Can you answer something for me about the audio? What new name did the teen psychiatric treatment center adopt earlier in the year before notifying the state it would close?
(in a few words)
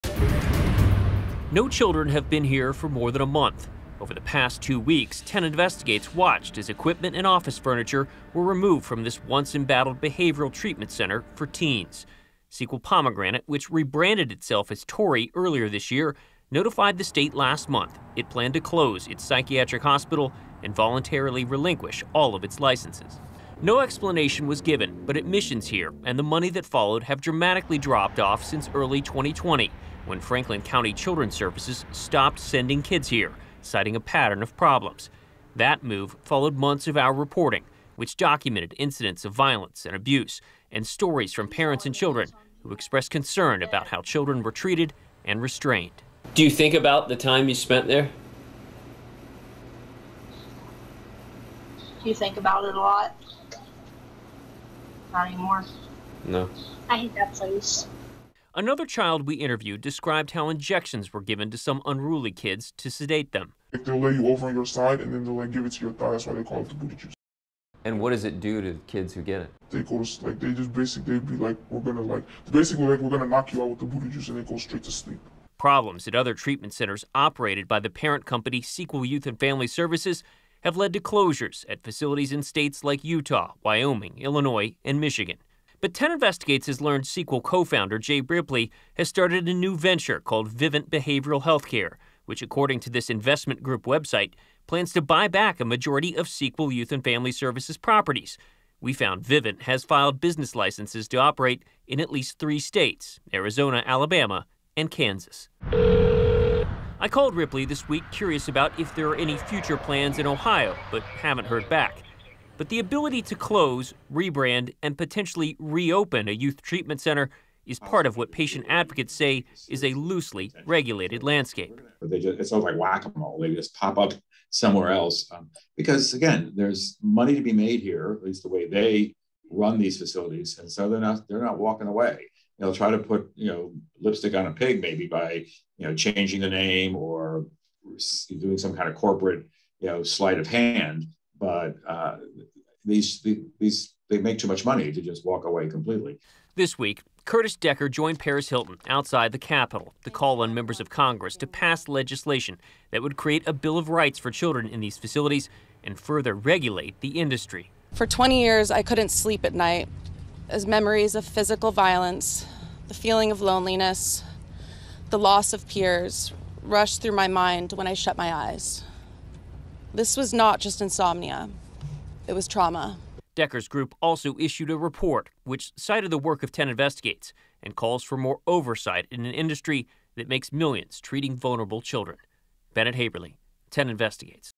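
Torii.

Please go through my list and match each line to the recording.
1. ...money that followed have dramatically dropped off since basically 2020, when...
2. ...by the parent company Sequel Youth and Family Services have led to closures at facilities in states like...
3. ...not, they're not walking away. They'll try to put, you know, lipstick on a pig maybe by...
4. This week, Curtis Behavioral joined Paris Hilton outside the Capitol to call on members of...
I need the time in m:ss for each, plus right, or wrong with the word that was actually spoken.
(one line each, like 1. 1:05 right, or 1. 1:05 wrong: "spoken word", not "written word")
1. 0:26 wrong: "early", not "basically"
2. 1:17 right
3. 2:10 right
4. 2:26 wrong: "Decker", not "Behavioral".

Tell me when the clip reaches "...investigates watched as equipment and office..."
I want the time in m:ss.
0:05.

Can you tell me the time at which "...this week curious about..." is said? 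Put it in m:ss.
1:47.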